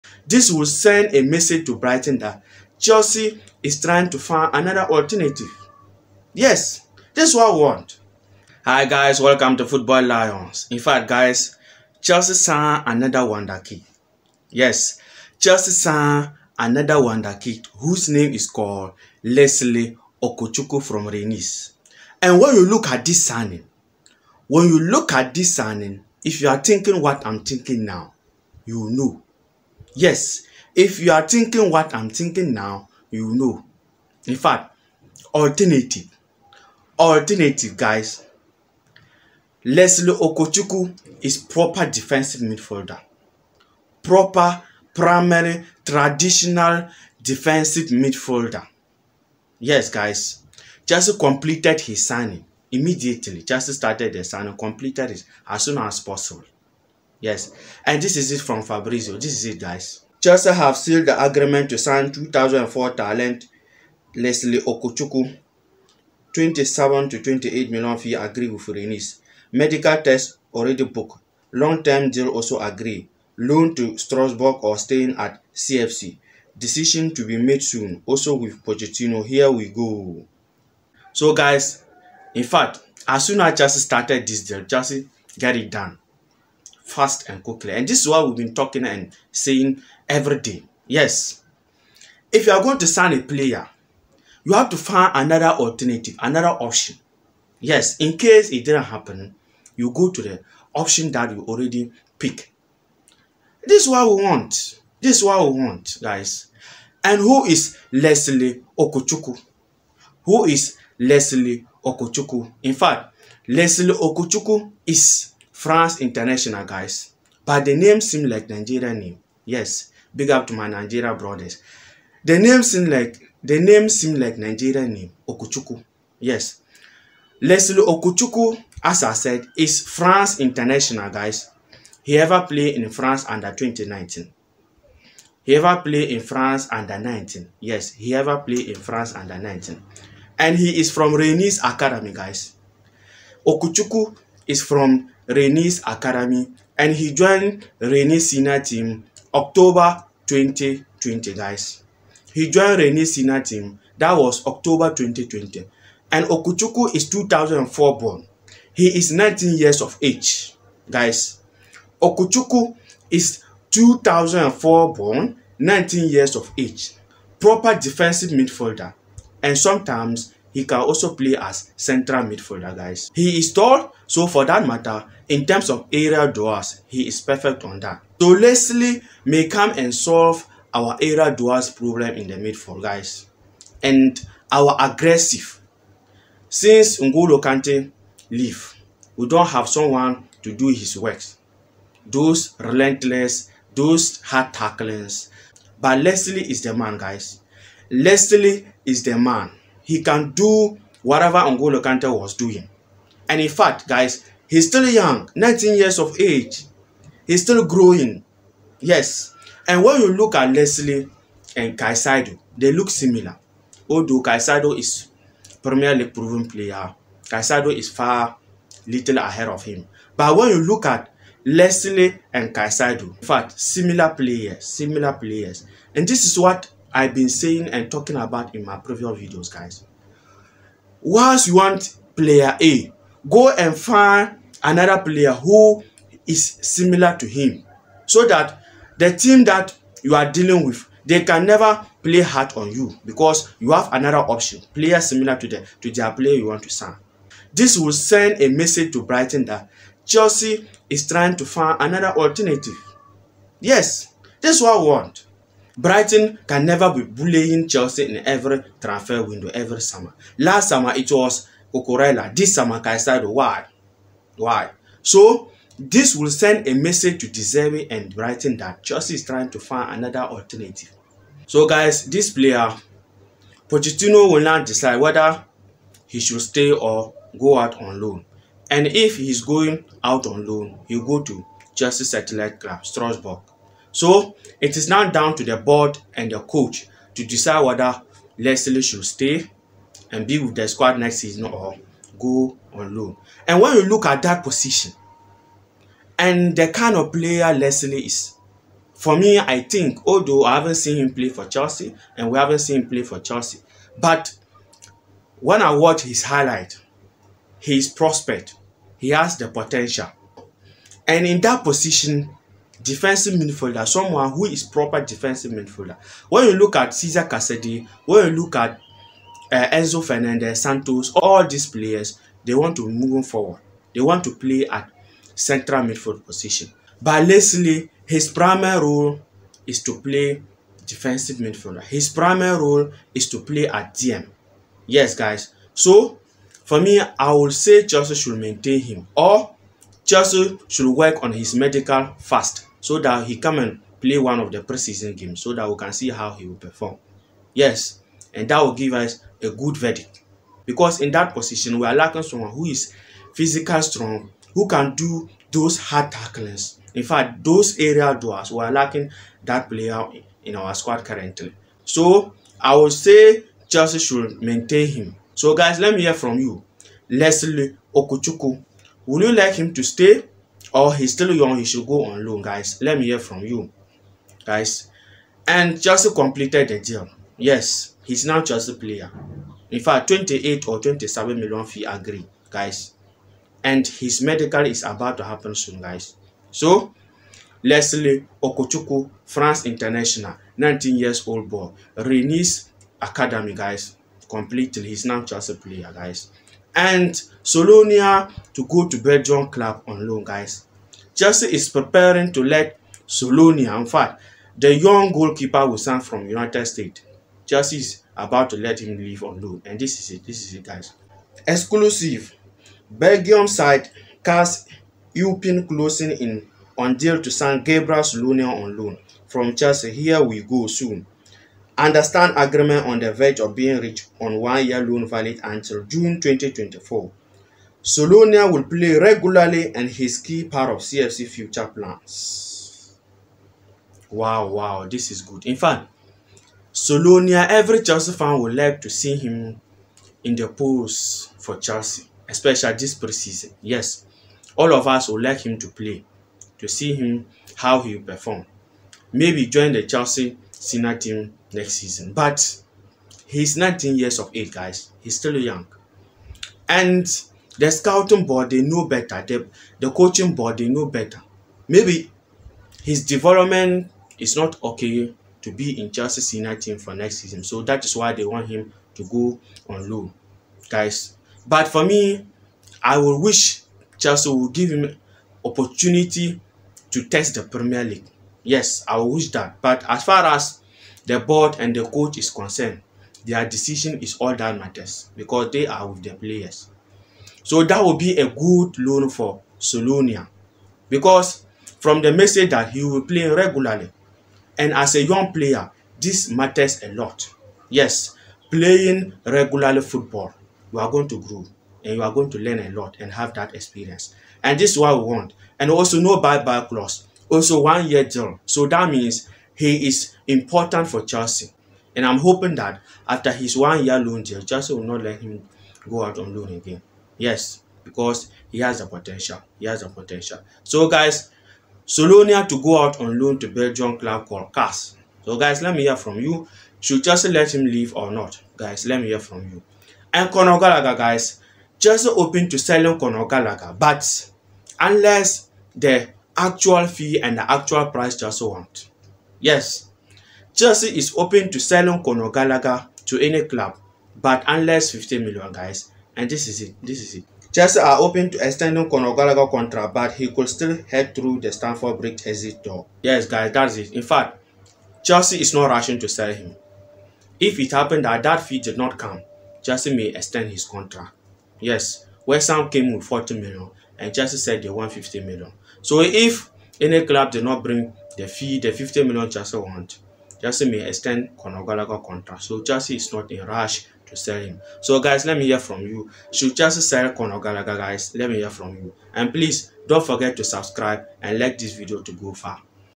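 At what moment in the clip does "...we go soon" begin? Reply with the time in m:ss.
7:00.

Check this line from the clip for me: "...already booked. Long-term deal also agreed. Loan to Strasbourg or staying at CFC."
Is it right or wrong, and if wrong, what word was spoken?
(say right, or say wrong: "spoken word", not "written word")
right.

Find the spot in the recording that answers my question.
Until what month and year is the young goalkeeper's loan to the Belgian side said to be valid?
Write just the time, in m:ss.
7:05.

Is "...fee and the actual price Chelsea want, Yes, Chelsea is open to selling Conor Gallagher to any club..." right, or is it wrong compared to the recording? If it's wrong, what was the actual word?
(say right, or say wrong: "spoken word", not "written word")
right.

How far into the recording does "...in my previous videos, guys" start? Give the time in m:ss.
3:48.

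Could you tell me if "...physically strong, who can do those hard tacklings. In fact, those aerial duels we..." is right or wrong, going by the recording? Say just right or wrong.
right.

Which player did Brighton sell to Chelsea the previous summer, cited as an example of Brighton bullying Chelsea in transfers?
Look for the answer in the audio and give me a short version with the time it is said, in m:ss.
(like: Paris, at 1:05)
Cucurella, at 4:21.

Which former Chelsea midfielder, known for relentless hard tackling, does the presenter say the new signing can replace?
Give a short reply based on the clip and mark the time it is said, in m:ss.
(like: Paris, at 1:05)
N'Golo Kante, at 3:06.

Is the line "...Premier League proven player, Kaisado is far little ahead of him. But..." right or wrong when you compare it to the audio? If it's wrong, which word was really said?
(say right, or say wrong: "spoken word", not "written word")
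right.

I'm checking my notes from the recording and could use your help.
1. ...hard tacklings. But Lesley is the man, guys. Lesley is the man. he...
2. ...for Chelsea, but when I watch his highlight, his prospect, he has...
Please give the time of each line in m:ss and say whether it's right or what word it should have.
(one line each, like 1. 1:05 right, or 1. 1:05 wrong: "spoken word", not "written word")
1. 3:14 right
2. 5:03 right.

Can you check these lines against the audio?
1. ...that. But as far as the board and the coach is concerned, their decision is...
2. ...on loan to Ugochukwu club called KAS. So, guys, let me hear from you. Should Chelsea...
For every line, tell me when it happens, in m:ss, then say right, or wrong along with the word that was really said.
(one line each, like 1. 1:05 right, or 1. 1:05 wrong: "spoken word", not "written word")
1. 7:59 right
2. 8:43 wrong: "Belgian", not "Ugochukwu".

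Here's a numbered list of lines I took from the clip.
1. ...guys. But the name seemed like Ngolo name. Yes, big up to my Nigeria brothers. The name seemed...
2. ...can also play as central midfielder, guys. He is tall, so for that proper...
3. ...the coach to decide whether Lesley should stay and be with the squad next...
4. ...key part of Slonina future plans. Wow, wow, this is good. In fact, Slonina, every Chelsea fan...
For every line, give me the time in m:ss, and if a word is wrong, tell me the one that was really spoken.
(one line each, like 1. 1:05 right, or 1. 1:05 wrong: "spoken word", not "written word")
1. 1:56 wrong: "Nigerian", not "Ngolo"
2. 2:50 wrong: "matter", not "proper"
3. 4:46 right
4. 7:10 wrong: "CFC", not "Slonina".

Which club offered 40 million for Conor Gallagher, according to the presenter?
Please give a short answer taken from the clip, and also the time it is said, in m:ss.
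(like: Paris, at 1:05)
West Ham, at 9:22.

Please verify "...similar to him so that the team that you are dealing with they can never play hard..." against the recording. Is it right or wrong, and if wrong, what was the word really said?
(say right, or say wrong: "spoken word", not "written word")
right.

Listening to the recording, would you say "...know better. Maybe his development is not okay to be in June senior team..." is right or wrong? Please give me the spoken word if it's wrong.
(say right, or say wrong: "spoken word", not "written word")
wrong: "Chelsea", not "June".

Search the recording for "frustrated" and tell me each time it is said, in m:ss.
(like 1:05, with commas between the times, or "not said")
not said.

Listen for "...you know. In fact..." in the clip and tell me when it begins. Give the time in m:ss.
0:33.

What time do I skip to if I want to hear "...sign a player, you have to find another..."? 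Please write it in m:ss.
1:32.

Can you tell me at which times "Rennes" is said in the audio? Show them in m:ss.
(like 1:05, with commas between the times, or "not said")
0:21, 2:21.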